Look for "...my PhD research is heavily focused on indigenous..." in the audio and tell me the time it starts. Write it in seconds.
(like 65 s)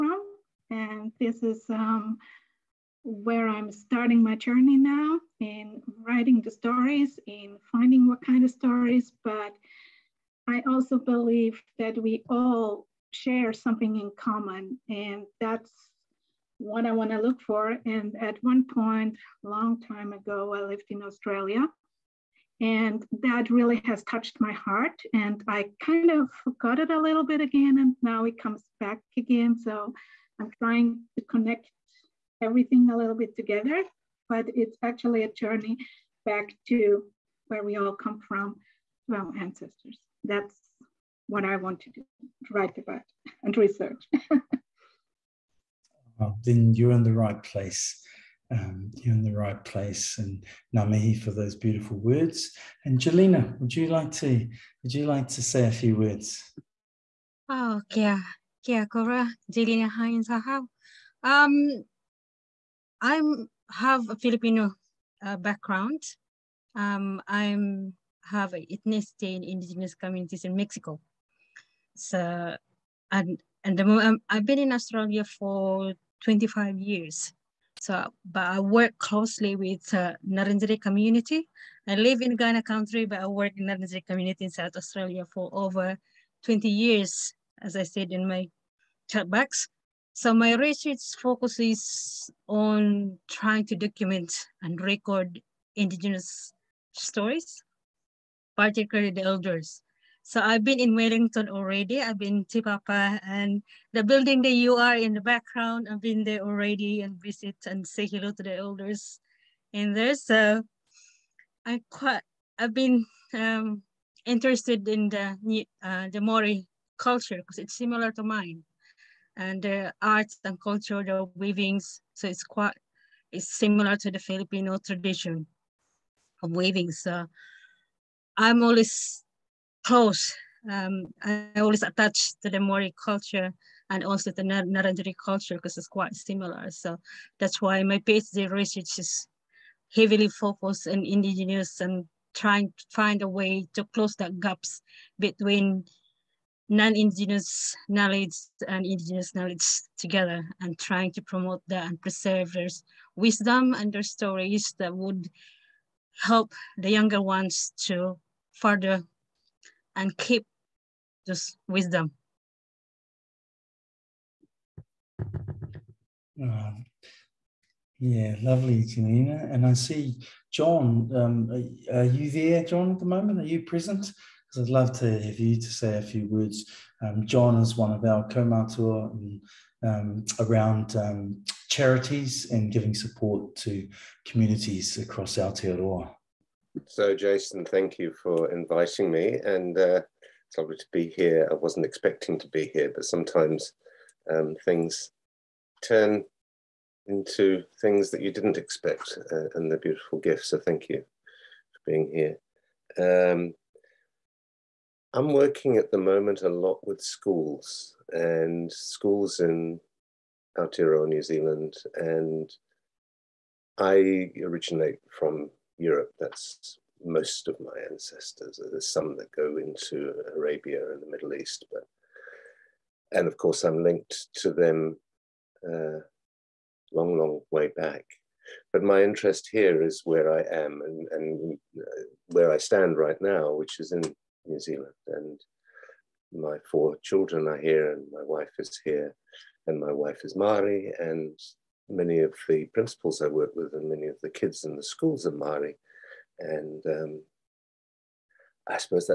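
137 s.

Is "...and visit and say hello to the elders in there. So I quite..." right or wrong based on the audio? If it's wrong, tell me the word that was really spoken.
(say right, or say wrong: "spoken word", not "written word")
right.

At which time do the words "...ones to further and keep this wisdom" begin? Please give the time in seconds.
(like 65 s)
157 s.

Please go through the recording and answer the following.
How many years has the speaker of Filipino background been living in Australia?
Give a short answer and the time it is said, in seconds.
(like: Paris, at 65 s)
25, at 76 s.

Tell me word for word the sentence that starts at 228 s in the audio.
But my interest here is where I am and, and uh, where I stand right now, which is in New Zealand.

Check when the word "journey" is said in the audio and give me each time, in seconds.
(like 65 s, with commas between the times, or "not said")
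4 s, 35 s.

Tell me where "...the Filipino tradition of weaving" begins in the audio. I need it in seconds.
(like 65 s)
124 s.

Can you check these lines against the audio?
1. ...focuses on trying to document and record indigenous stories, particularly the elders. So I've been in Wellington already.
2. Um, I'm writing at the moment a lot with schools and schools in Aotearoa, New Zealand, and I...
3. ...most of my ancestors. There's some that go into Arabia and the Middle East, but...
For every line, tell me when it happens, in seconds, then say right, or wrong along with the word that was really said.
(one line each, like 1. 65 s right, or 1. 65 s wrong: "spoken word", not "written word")
1. 91 s right
2. 202 s wrong: "working", not "writing"
3. 217 s right.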